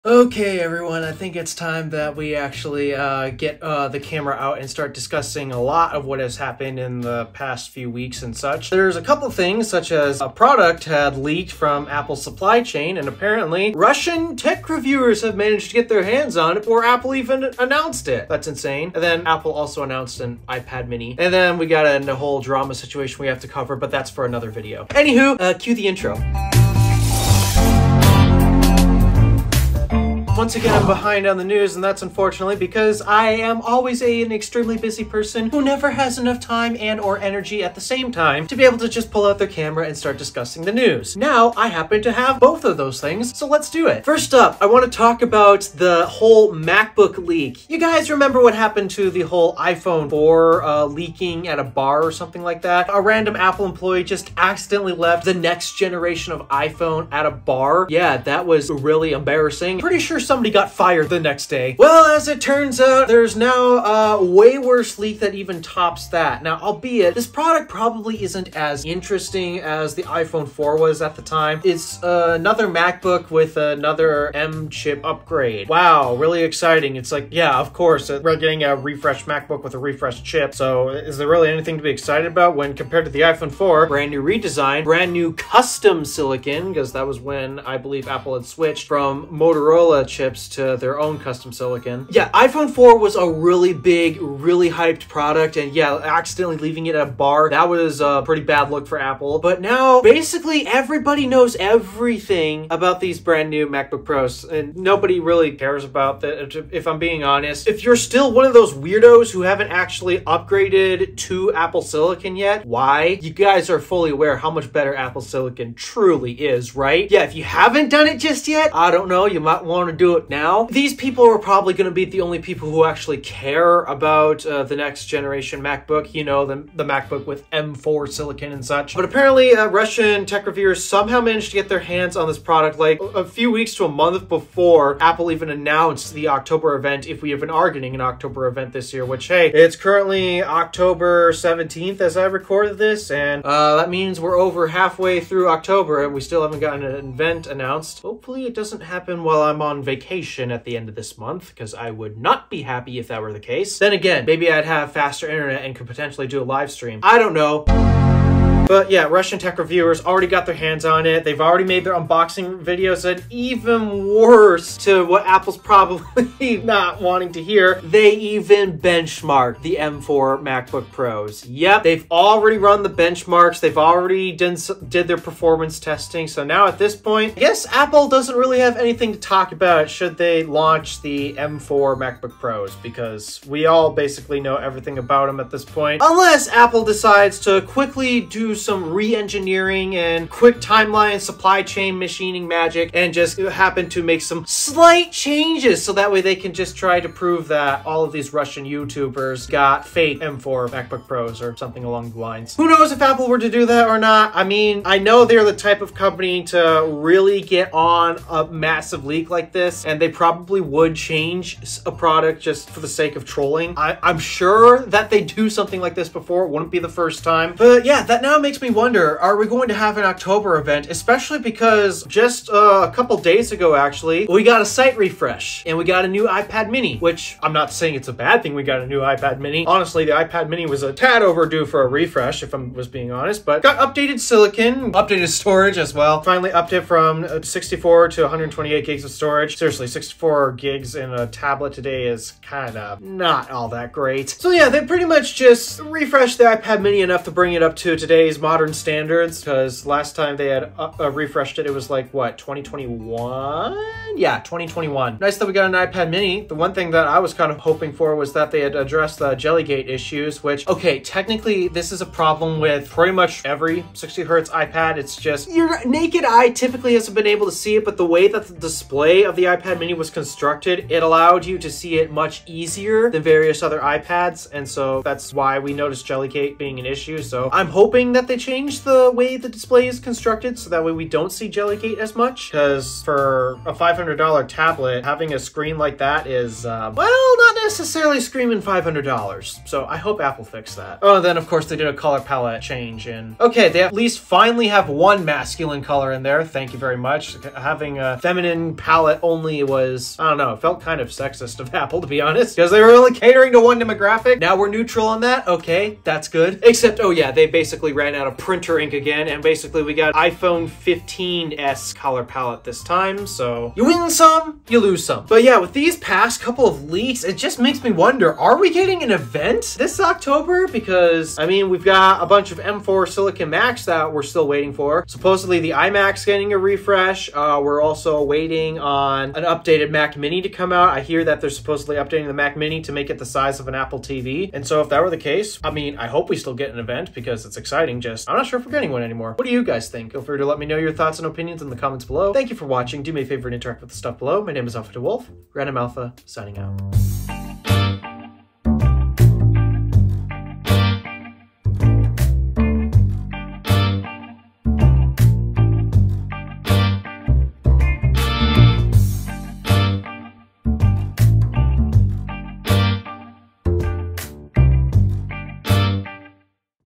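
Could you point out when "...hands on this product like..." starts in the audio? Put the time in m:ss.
2:11.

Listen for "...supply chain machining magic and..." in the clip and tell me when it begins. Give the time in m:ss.
3:11.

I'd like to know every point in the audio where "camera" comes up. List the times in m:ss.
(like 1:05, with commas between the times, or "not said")
0:03, 0:39.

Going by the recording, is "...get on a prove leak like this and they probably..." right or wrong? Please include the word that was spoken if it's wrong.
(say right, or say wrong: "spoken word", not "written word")
wrong: "massive", not "prove".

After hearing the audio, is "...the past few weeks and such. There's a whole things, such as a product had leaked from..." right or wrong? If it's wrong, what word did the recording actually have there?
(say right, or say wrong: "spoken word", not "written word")
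wrong: "couple", not "whole".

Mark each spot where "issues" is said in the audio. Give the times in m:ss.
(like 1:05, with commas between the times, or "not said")
4:19, 4:36.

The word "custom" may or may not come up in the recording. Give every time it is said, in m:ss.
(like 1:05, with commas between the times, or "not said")
1:25, 1:31.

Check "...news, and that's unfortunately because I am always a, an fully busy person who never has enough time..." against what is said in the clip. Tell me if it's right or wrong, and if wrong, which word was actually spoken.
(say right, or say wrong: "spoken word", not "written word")
wrong: "extremely", not "fully".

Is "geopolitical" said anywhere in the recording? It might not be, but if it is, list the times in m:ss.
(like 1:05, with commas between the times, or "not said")
not said.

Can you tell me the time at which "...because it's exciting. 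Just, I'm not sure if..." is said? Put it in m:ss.
5:37.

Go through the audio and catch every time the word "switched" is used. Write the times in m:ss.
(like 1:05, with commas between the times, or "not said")
1:28.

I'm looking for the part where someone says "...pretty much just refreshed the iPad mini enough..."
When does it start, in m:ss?
4:04.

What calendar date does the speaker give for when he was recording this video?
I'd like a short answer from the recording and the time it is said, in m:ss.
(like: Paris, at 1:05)
October 17th, at 2:20.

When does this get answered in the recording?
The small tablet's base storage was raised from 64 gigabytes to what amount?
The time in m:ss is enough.
3:58.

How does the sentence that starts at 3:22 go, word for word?
Who knows if Apple were to do that or not?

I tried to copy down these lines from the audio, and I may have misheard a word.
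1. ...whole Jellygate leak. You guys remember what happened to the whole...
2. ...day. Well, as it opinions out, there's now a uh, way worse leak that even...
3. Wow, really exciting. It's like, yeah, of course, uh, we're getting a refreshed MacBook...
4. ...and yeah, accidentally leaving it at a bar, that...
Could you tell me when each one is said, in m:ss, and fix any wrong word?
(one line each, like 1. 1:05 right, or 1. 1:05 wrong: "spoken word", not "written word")
1. 0:46 wrong: "MacBook", not "Jellygate"
2. 1:01 wrong: "turns", not "opinions"
3. 1:15 right
4. 1:35 right.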